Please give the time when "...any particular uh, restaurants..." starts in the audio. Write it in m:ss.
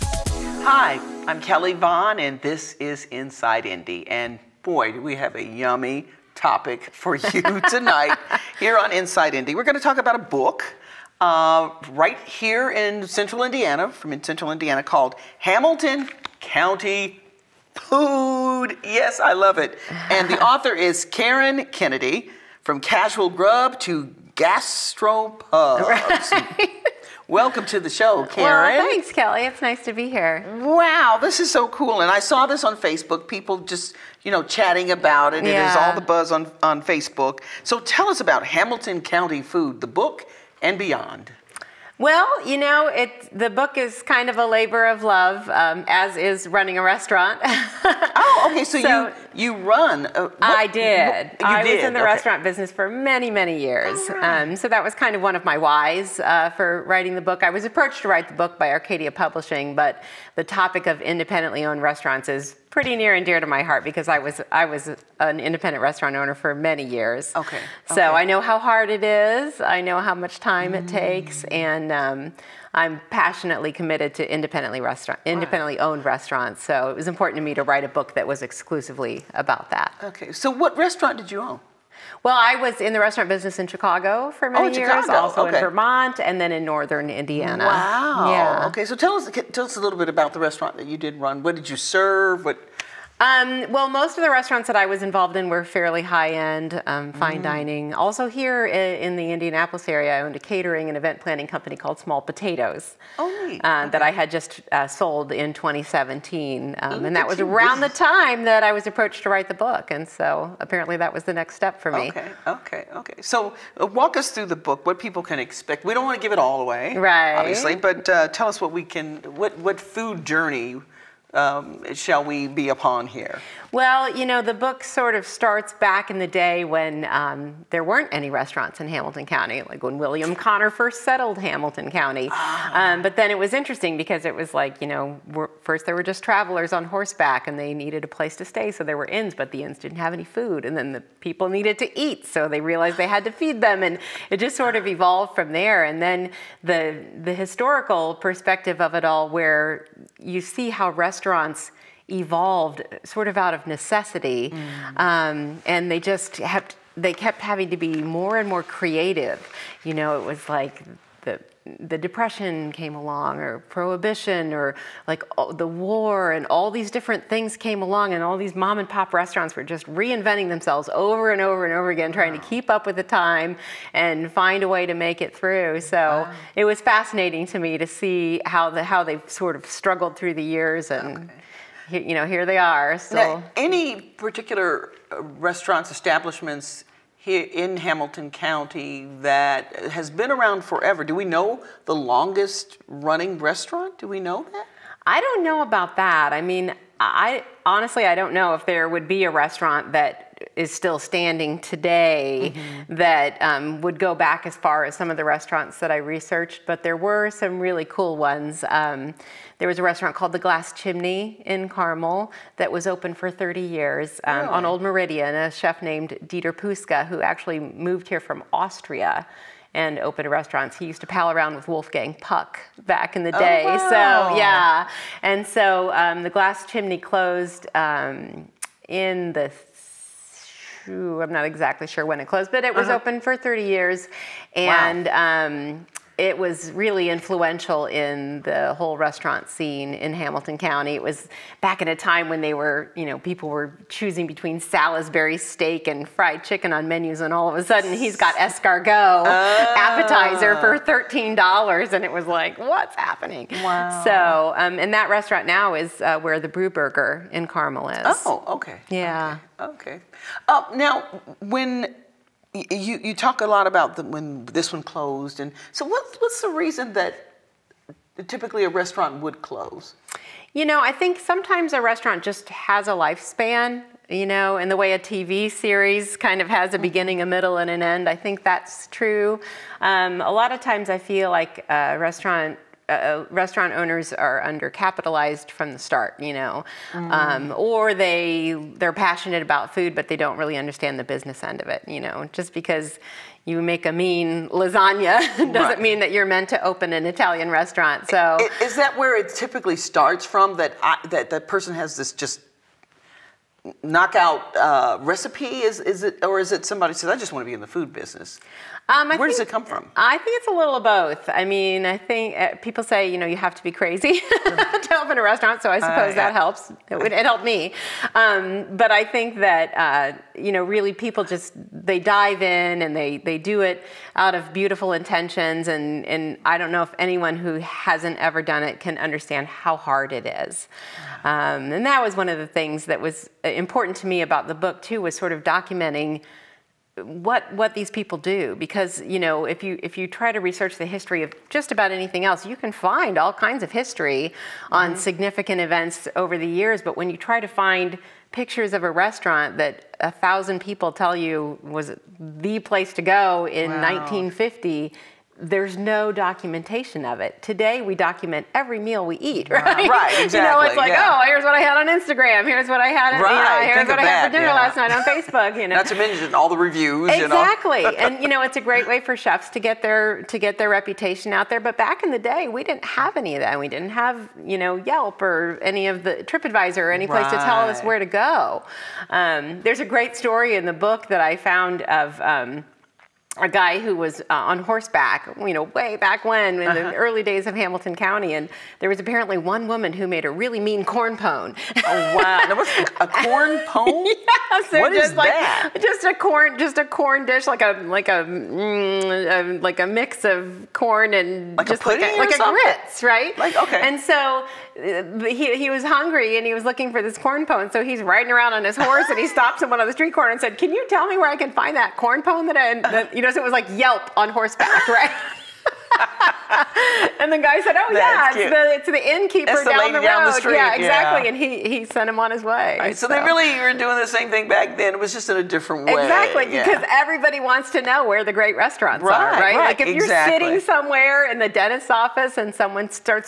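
3:03.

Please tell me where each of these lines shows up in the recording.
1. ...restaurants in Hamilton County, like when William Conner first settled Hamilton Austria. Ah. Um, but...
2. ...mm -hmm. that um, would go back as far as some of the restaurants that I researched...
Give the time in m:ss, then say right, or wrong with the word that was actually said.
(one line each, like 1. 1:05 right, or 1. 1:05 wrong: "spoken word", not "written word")
1. 2:08 wrong: "County", not "Austria"
2. 3:22 right.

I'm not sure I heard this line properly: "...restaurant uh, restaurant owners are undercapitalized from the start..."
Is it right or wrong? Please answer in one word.
right.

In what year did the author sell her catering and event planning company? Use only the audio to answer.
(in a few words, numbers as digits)
2017.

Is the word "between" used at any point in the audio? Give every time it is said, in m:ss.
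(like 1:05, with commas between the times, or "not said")
4:04.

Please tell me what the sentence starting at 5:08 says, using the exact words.
Um, Where think, does it come from?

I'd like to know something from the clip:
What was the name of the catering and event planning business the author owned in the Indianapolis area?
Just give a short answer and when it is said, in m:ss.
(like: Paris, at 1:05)
Small Potatoes, at 1:41.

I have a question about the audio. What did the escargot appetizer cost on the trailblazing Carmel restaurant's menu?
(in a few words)
$13.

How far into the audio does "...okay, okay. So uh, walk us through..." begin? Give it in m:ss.
1:52.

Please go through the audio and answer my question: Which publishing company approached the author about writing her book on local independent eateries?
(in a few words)
Arcadia Publishing.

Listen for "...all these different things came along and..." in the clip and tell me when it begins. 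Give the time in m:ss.
2:46.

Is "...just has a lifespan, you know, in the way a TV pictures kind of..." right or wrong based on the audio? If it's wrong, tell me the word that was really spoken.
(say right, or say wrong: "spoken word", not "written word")
wrong: "series", not "pictures".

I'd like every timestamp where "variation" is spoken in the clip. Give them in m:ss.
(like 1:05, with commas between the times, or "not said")
not said.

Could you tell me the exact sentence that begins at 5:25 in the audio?
And, and I don't know if anyone who hasn't ever done it can understand how hard it is.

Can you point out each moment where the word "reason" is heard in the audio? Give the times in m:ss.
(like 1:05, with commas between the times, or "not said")
4:26.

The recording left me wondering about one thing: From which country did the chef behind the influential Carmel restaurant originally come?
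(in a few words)
Austria.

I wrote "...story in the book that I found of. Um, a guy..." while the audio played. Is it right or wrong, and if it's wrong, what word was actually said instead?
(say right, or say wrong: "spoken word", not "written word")
right.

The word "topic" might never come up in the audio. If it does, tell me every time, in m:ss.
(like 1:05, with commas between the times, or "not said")
0:06, 1:00.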